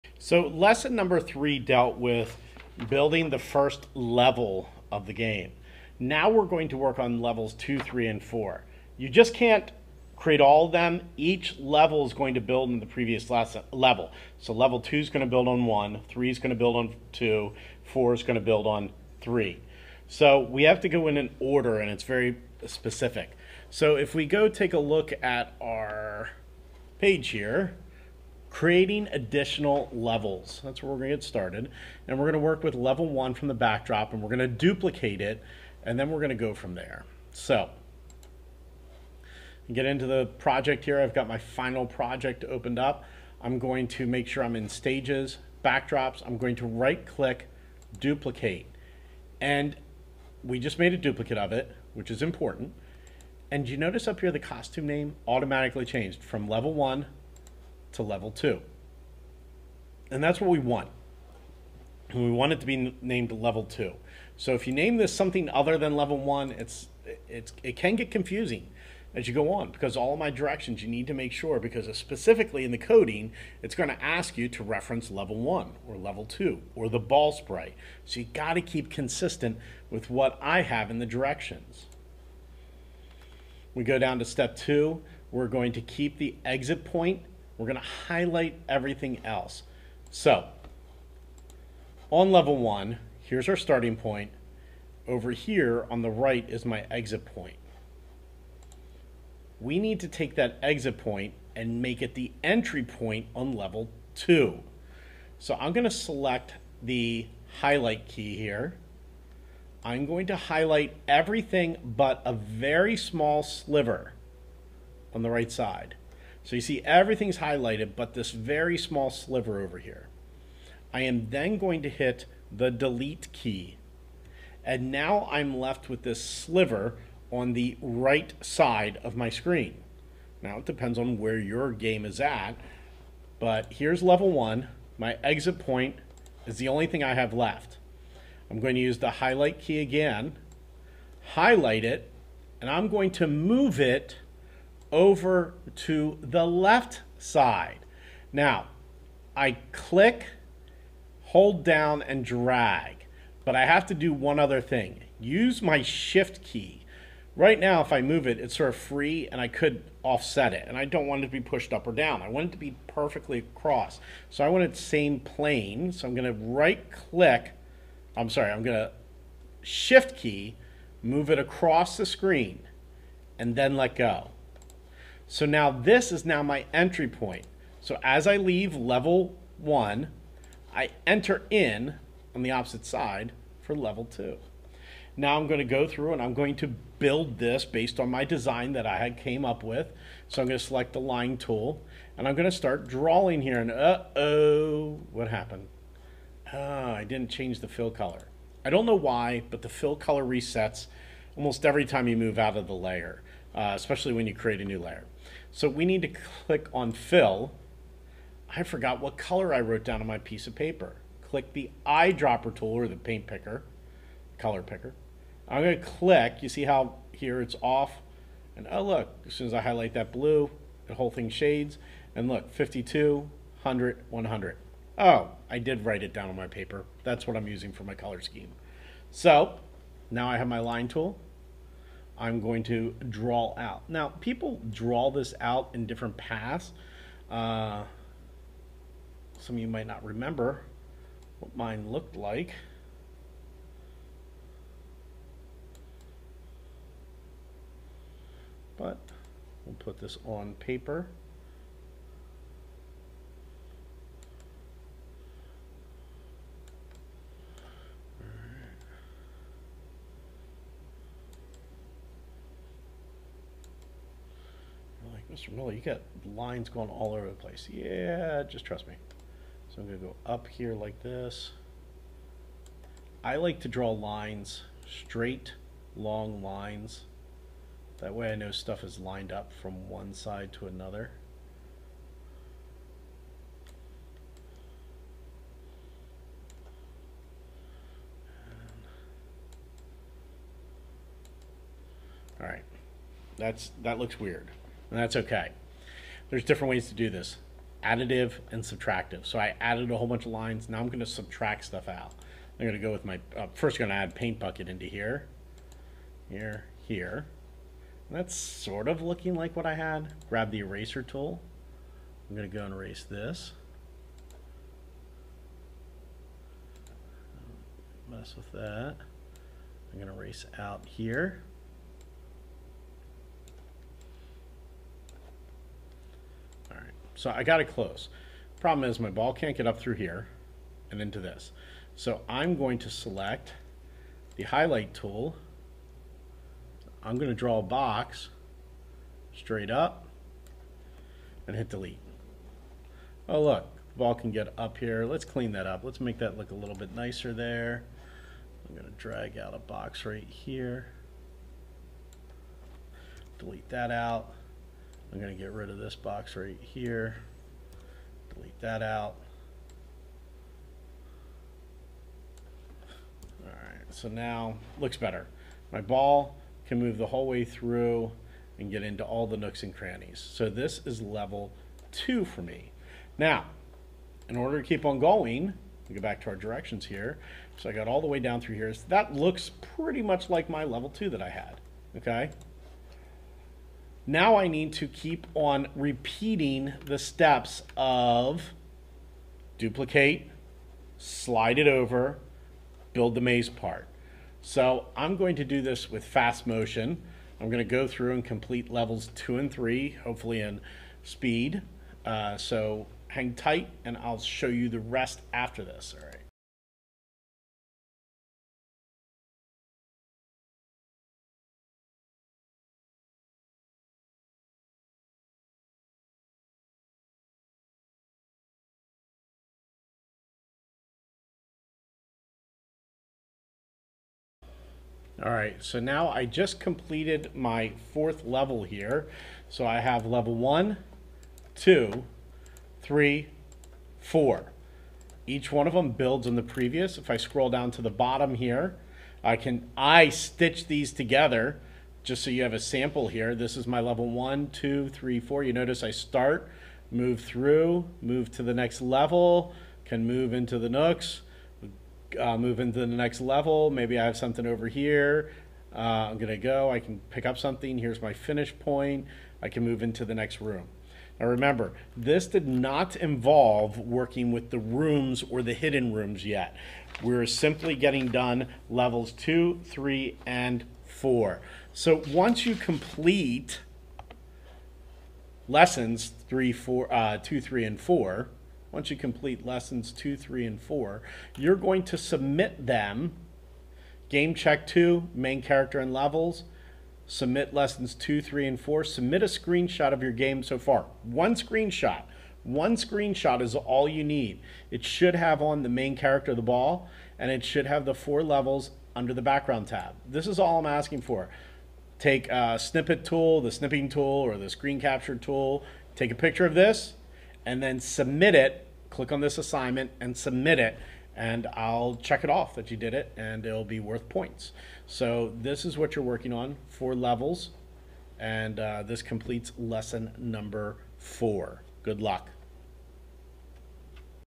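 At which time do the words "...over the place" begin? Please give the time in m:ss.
4:27.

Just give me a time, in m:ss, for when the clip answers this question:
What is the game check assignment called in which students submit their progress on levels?
8:05.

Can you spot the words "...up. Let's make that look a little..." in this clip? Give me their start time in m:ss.
5:45.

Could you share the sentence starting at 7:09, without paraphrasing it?
So I have level one, two, three, four.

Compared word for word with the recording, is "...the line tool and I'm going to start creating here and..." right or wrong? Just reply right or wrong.
wrong.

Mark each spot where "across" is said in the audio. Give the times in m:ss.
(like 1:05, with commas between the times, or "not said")
2:43, 2:51.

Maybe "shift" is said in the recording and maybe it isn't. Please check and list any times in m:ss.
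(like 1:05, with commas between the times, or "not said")
2:35, 2:49.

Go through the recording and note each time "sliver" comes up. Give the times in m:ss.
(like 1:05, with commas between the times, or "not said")
1:53, 1:59, 2:06.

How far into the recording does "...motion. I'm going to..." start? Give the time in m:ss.
6:36.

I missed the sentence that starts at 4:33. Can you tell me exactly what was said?
I like to draw lines, straight, long lines.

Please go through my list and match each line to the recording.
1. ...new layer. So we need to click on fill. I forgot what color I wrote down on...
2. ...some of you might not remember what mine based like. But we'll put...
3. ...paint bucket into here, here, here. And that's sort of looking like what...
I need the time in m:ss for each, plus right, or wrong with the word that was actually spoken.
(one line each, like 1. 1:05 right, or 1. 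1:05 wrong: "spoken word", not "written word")
1. 3:24 right
2. 3:59 wrong: "looked", not "based"
3. 5:04 right.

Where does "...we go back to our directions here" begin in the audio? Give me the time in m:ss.
6:15.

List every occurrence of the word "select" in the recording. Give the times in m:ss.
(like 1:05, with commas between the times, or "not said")
1:45, 3:10, 5:32.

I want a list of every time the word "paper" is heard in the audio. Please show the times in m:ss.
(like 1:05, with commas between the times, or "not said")
3:30, 3:46, 4:10.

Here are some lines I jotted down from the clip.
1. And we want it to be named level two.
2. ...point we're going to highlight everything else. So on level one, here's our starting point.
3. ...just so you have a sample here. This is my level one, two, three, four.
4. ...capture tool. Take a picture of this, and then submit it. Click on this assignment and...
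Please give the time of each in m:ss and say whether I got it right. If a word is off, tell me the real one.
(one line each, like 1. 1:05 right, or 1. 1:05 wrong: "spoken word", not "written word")
1. 1:02 right
2. 1:26 right
3. 7:22 right
4. 8:24 right.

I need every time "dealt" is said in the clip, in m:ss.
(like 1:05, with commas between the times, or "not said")
0:01.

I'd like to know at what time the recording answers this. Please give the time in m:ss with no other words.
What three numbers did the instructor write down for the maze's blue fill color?
3:42.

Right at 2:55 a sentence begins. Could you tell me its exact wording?
So now this is now my entry point.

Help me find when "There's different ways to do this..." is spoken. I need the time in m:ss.
4:56.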